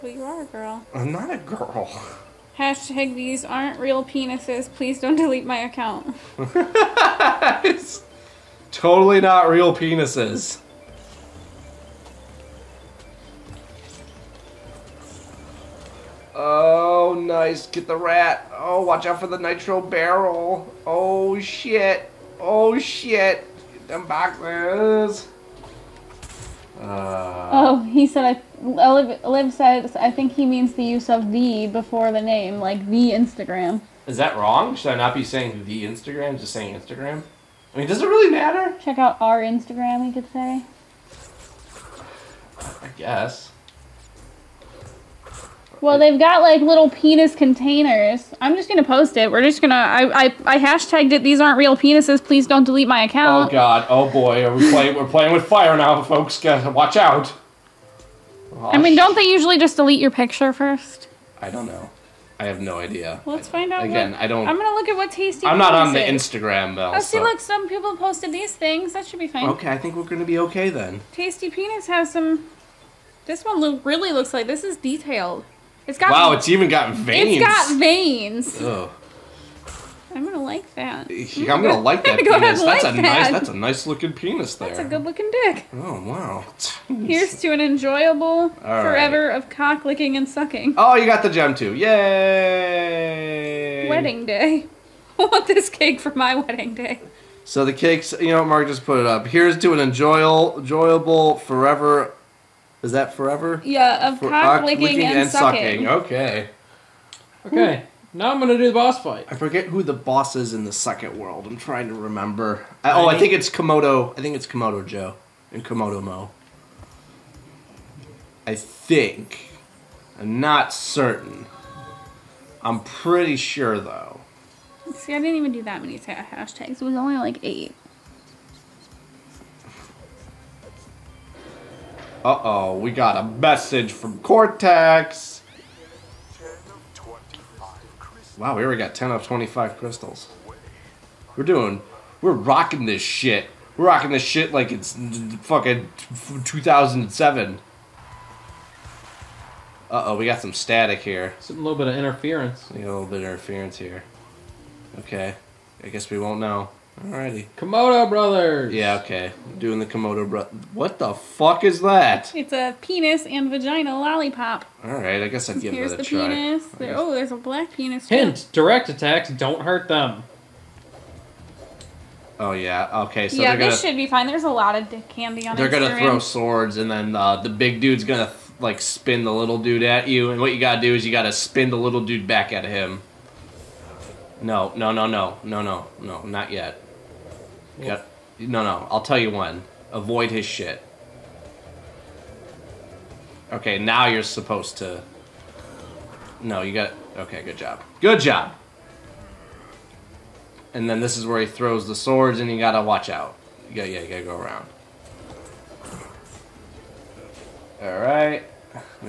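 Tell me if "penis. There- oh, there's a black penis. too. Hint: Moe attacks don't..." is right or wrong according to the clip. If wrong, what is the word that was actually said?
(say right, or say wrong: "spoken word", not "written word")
wrong: "Direct", not "Moe".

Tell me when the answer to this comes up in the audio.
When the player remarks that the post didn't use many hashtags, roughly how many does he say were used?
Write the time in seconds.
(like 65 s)
127 s.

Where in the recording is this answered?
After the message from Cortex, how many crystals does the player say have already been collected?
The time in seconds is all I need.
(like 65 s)
138 s.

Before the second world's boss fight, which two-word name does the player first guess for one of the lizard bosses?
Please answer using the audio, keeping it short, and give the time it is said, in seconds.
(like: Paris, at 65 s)
Komodo Joe, at 114 s.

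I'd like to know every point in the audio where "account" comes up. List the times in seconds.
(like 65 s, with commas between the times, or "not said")
5 s, 53 s.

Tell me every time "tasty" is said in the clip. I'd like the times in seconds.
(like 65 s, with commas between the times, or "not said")
65 s, 71 s.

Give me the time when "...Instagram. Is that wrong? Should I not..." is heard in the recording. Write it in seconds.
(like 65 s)
33 s.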